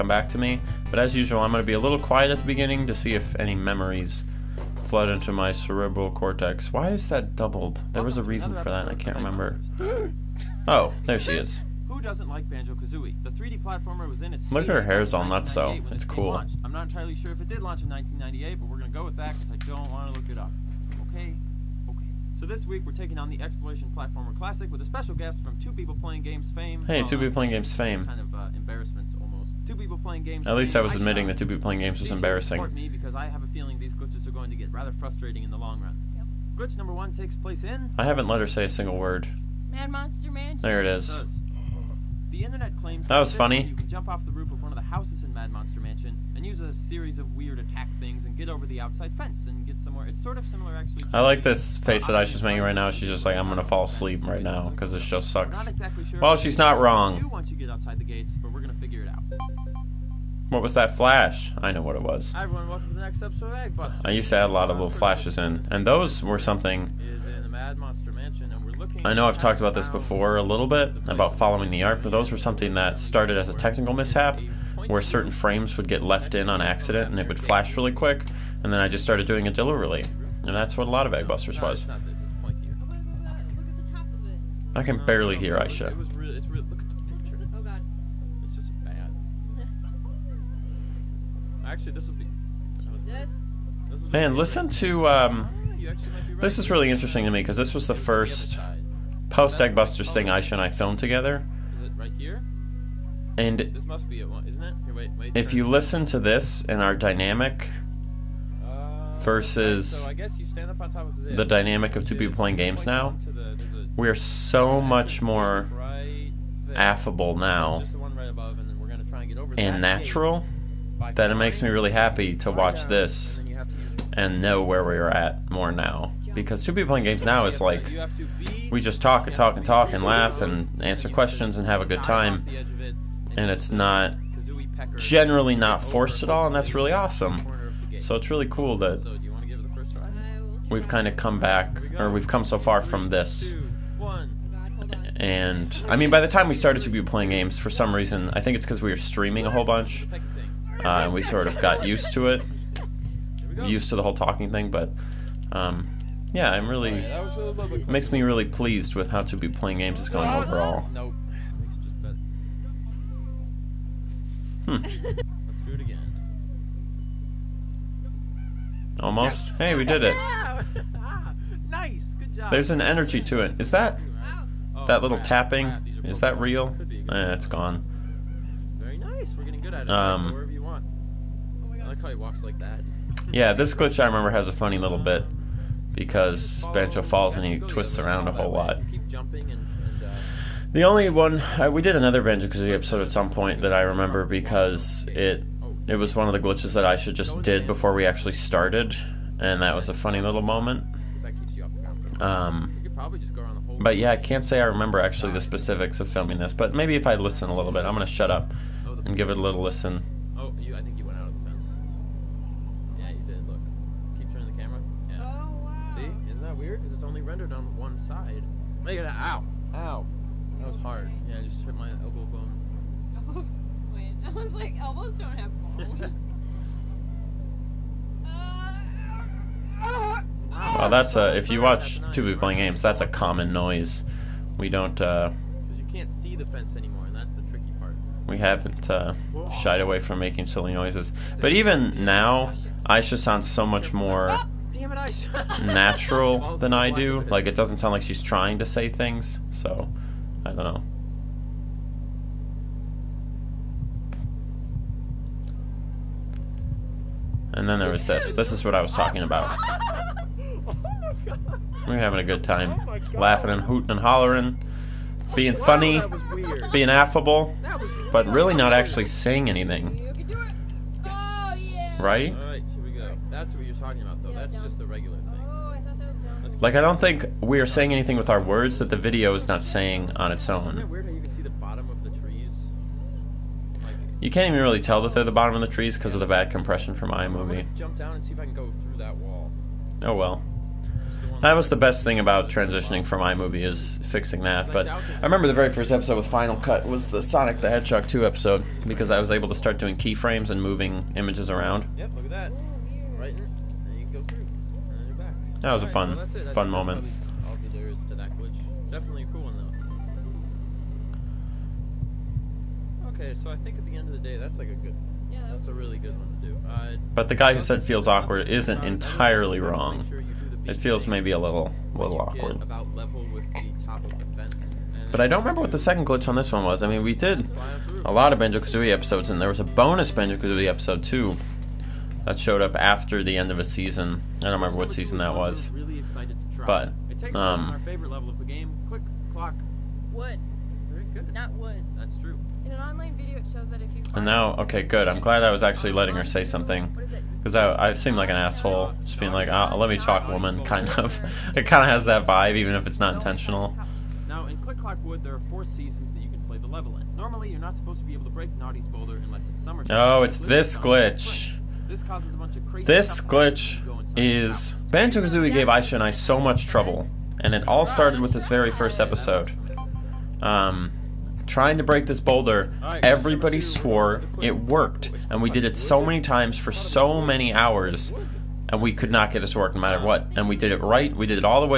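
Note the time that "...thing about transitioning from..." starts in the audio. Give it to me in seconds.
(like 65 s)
292 s.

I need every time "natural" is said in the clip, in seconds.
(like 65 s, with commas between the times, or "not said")
119 s, 245 s.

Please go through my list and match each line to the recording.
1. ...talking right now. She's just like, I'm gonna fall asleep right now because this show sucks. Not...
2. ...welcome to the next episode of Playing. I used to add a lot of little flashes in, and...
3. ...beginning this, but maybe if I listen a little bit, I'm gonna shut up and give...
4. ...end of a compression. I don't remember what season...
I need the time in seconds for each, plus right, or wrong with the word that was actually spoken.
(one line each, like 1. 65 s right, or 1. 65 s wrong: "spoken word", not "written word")
1. 52 s wrong: "making", not "talking"
2. 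62 s wrong: "Eggbuster", not "Playing"
3. 206 s wrong: "filming", not "beginning"
4. 333 s wrong: "season", not "compression".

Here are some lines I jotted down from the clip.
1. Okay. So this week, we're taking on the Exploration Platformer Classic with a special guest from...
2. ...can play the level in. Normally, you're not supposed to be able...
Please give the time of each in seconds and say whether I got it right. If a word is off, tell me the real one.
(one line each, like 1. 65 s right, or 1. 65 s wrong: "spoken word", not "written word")
1. 21 s right
2. 356 s right.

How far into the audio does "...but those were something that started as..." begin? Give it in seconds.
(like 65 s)
72 s.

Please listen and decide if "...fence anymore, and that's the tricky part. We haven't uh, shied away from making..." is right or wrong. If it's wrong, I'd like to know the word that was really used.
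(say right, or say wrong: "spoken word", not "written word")
right.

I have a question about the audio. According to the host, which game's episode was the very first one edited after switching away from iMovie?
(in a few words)
Sonic the Hedgehog 2.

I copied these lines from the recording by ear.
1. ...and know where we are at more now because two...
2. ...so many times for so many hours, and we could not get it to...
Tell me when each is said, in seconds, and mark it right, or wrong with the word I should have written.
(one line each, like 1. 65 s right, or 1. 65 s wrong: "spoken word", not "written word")
1. 124 s right
2. 375 s right.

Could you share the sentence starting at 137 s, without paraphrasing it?
So it's really cool that we've kind of come back or we've come so far from this.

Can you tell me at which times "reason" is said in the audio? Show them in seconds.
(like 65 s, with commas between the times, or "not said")
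8 s, 147 s.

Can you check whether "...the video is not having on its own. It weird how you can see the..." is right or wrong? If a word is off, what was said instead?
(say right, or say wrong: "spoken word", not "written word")
wrong: "saying", not "having".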